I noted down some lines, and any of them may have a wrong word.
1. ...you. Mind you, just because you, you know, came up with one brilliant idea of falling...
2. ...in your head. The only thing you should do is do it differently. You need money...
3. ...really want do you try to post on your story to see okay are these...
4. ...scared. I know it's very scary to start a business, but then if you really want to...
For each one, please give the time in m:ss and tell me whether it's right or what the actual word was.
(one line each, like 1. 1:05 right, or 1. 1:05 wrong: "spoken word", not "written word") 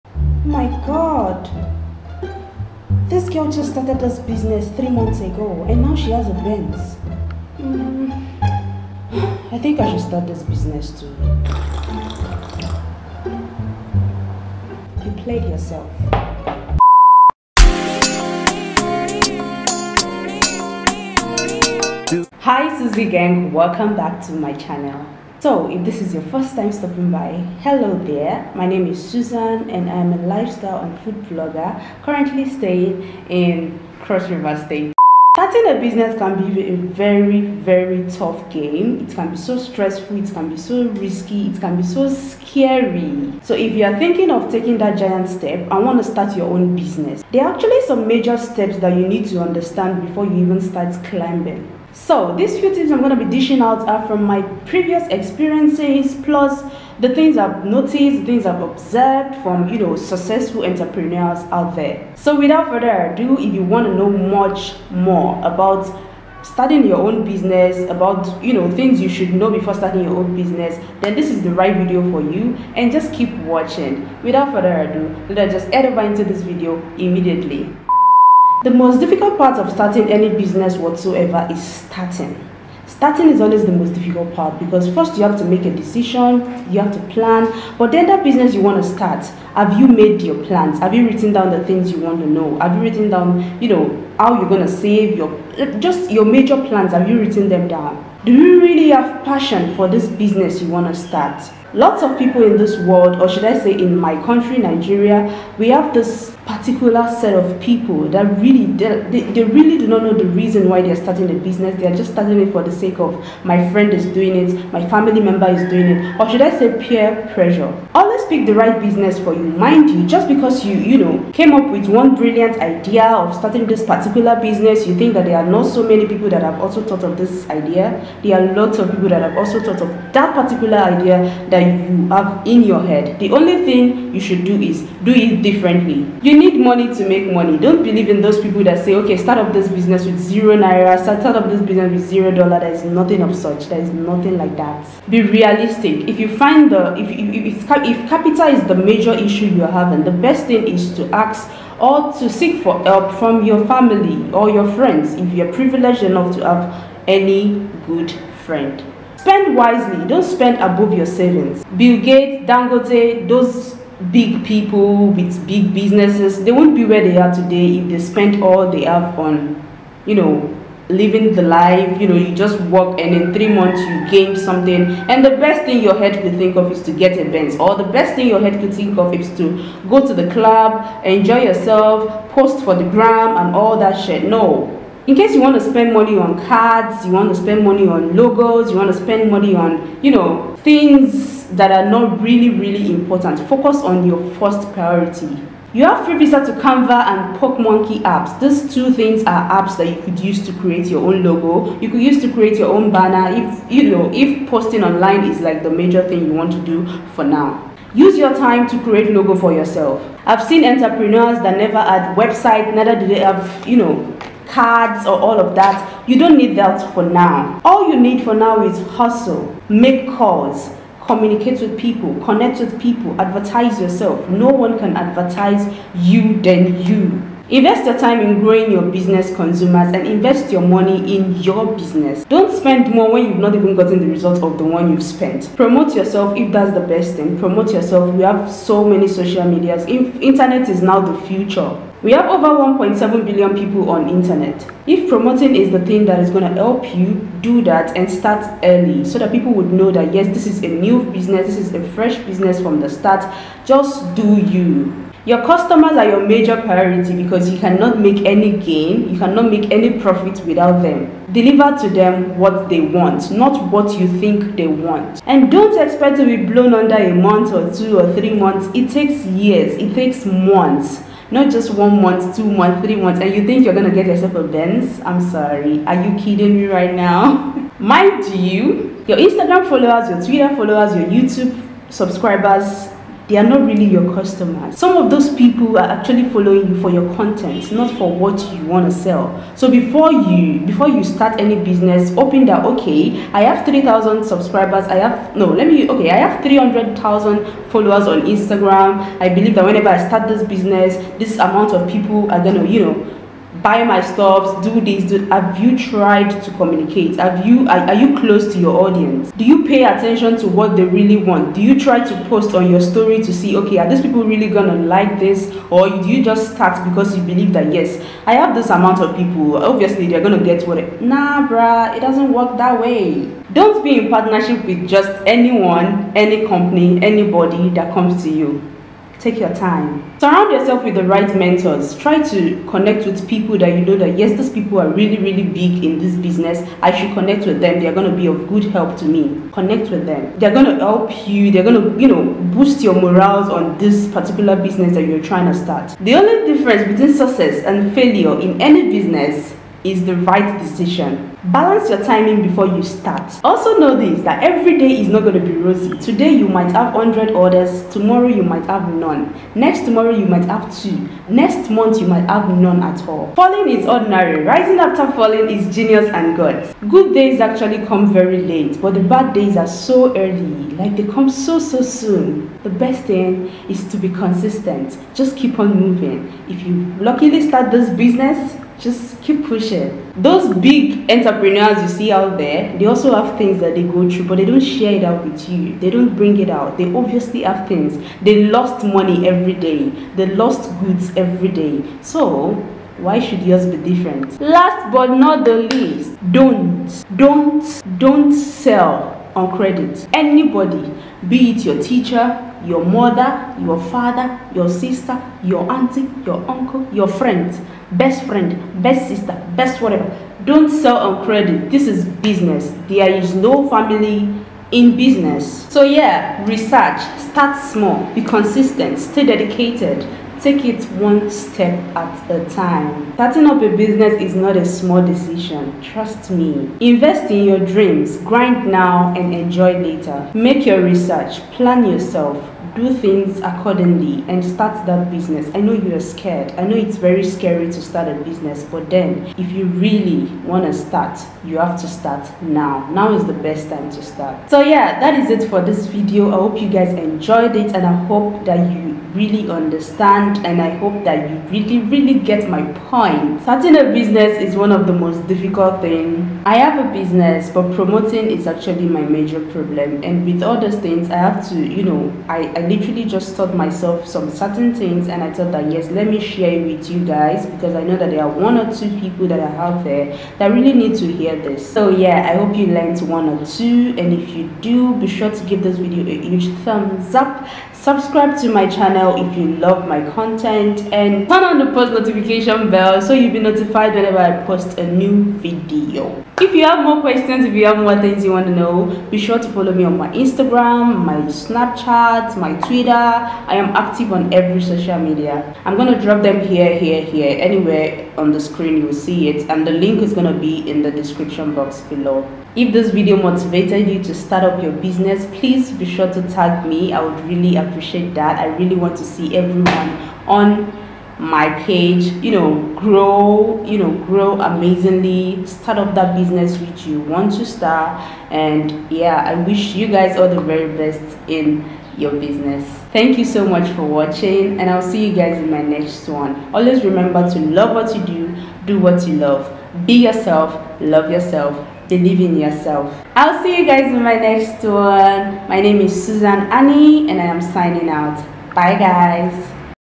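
1. 1:59 wrong: "starting", not "falling"
2. 2:12 right
3. 5:10 right
4. 7:15 right.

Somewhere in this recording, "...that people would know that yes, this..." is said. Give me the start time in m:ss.
4:09.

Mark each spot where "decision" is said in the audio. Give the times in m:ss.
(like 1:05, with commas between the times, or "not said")
1:25, 5:50, 7:05.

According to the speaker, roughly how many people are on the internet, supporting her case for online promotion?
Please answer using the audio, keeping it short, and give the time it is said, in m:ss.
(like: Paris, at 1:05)
1.7 billion, at 4:02.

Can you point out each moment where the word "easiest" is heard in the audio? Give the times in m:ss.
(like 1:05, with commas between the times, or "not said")
not said.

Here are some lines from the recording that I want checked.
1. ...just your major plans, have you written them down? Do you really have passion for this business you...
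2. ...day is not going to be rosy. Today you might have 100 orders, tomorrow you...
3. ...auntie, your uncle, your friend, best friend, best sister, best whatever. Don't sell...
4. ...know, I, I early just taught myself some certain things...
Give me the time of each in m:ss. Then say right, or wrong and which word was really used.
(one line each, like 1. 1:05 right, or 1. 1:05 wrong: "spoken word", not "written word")
1. 1:35 right
2. 5:54 right
3. 6:45 right
4. 7:41 wrong: "literally", not "early".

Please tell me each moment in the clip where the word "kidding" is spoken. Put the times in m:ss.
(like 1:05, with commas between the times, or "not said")
4:36.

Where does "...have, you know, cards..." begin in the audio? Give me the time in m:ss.
3:33.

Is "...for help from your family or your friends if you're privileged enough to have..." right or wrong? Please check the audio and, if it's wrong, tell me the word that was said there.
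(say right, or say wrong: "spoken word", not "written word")
right.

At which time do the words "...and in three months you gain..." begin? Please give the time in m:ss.
2:52.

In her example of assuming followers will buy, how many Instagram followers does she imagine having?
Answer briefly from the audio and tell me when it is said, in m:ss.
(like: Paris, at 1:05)
300,000, at 4:56.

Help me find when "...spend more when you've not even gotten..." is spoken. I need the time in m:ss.
3:52.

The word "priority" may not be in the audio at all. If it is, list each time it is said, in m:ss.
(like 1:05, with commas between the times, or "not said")
3:14, 4:16.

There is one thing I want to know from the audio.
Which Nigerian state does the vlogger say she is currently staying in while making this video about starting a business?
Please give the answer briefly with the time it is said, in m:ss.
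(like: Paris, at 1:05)
Cross River State, at 0:34.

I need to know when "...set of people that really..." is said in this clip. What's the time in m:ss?
1:47.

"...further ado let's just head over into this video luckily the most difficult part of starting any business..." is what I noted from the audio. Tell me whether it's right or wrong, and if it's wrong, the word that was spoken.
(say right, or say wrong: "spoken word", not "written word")
wrong: "immediately", not "luckily".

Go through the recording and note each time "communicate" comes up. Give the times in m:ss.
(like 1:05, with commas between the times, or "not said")
3:41, 5:06.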